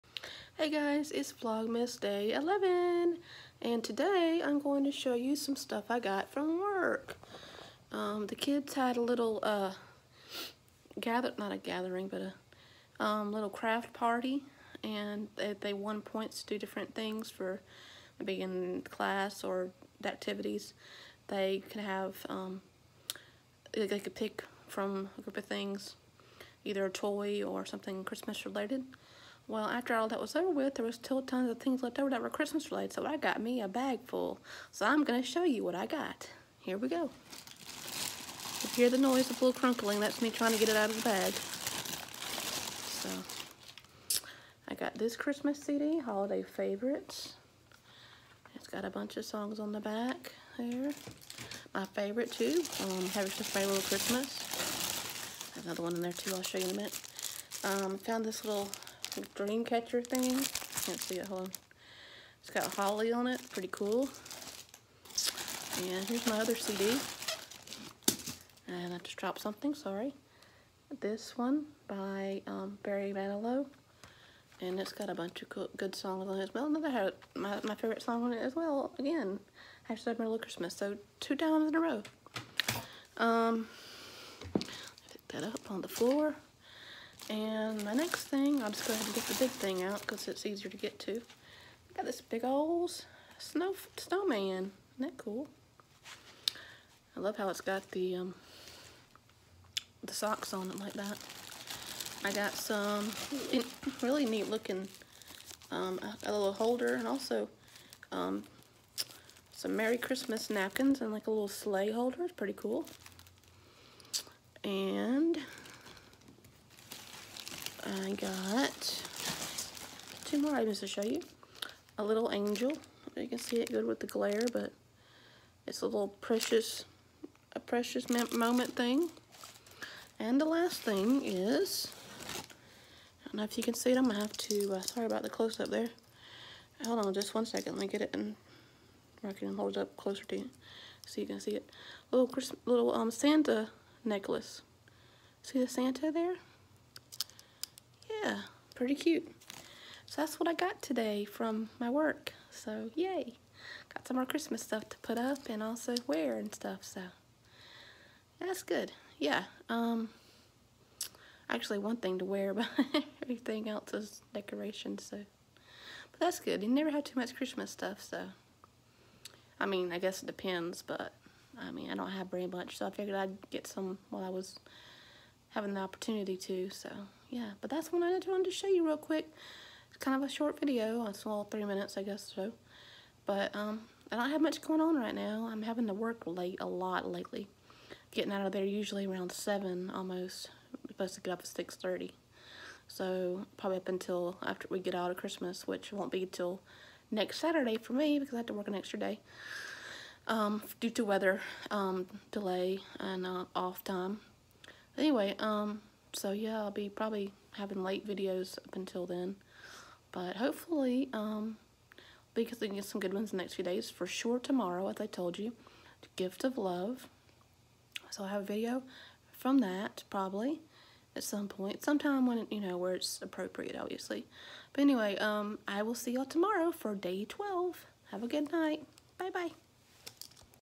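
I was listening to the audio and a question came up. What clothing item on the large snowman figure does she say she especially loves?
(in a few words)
Socks.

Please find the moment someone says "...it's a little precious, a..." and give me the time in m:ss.
2:05.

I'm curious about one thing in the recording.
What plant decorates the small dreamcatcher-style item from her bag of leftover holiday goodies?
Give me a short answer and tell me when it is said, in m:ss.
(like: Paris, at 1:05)
Holly, at 1:02.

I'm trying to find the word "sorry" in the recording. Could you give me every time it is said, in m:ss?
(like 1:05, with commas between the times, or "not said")
1:09, 2:14.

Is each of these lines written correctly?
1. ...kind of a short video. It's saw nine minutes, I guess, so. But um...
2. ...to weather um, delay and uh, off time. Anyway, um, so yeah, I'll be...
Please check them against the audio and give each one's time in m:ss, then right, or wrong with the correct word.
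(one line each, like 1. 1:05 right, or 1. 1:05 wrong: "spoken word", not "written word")
1. 2:59 wrong: "three", not "nine"
2. 3:20 right.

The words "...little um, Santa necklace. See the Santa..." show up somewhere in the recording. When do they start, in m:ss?
2:22.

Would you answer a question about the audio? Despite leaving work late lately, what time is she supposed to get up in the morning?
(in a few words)
6:30.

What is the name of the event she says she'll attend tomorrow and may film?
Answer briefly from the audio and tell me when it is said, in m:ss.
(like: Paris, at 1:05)
Gift of Love, at 3:36.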